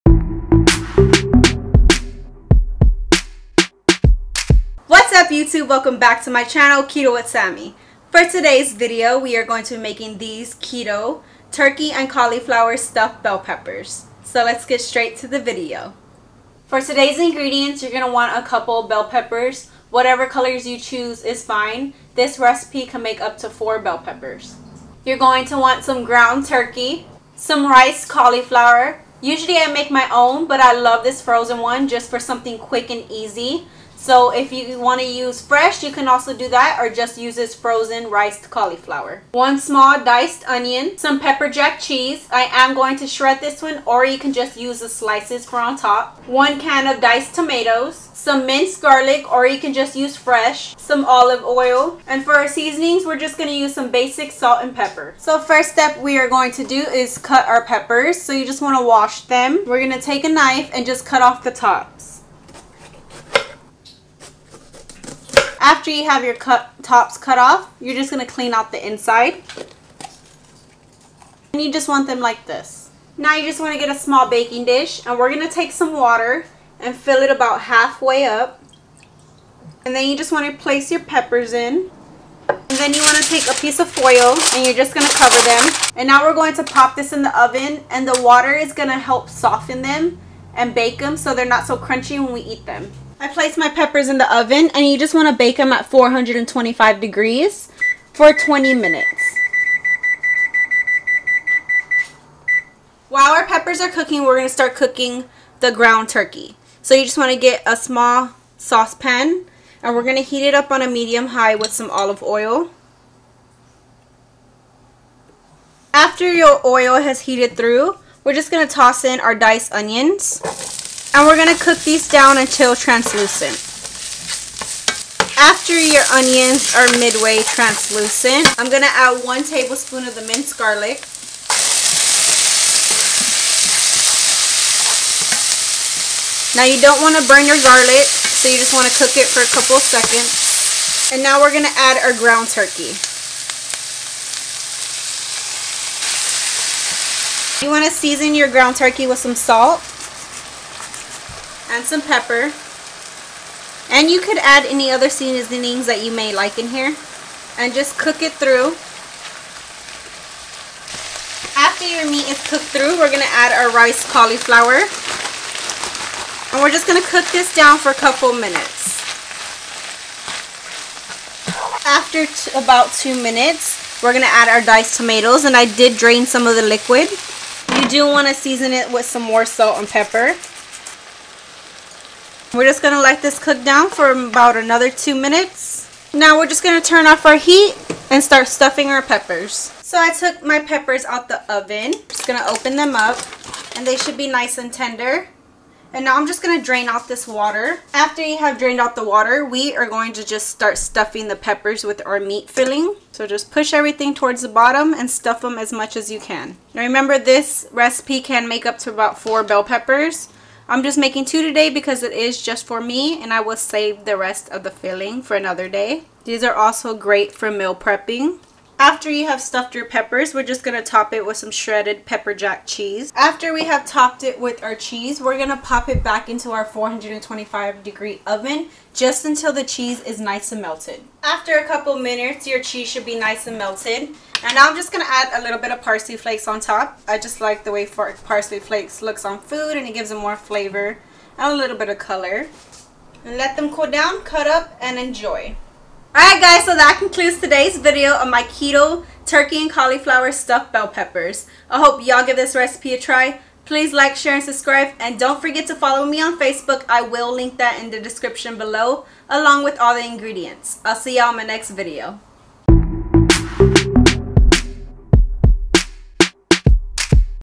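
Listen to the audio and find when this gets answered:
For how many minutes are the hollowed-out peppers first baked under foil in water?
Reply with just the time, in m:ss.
1:38.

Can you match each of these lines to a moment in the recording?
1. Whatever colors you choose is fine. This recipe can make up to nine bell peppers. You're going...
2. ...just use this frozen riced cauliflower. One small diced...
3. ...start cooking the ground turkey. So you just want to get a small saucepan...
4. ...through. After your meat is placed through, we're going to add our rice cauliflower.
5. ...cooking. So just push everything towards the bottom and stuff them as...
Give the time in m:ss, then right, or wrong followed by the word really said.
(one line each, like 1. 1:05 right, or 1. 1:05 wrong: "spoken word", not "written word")
1. 0:19 wrong: "four", not "nine"
2. 0:36 right
3. 1:44 right
4. 2:38 wrong: "cooked", not "placed"
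5. 3:22 wrong: "filling", not "cooking".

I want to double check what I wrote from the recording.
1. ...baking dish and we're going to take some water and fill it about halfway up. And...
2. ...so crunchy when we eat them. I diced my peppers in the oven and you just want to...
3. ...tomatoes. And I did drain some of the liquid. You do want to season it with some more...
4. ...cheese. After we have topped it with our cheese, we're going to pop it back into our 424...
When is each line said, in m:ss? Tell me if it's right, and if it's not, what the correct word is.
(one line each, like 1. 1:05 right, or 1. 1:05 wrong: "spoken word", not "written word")
1. 1:14 right
2. 1:31 wrong: "placed", not "diced"
3. 2:54 right
4. 3:42 wrong: "425", not "424".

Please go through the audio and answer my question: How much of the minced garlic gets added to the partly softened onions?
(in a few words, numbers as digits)
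1 tablespoon.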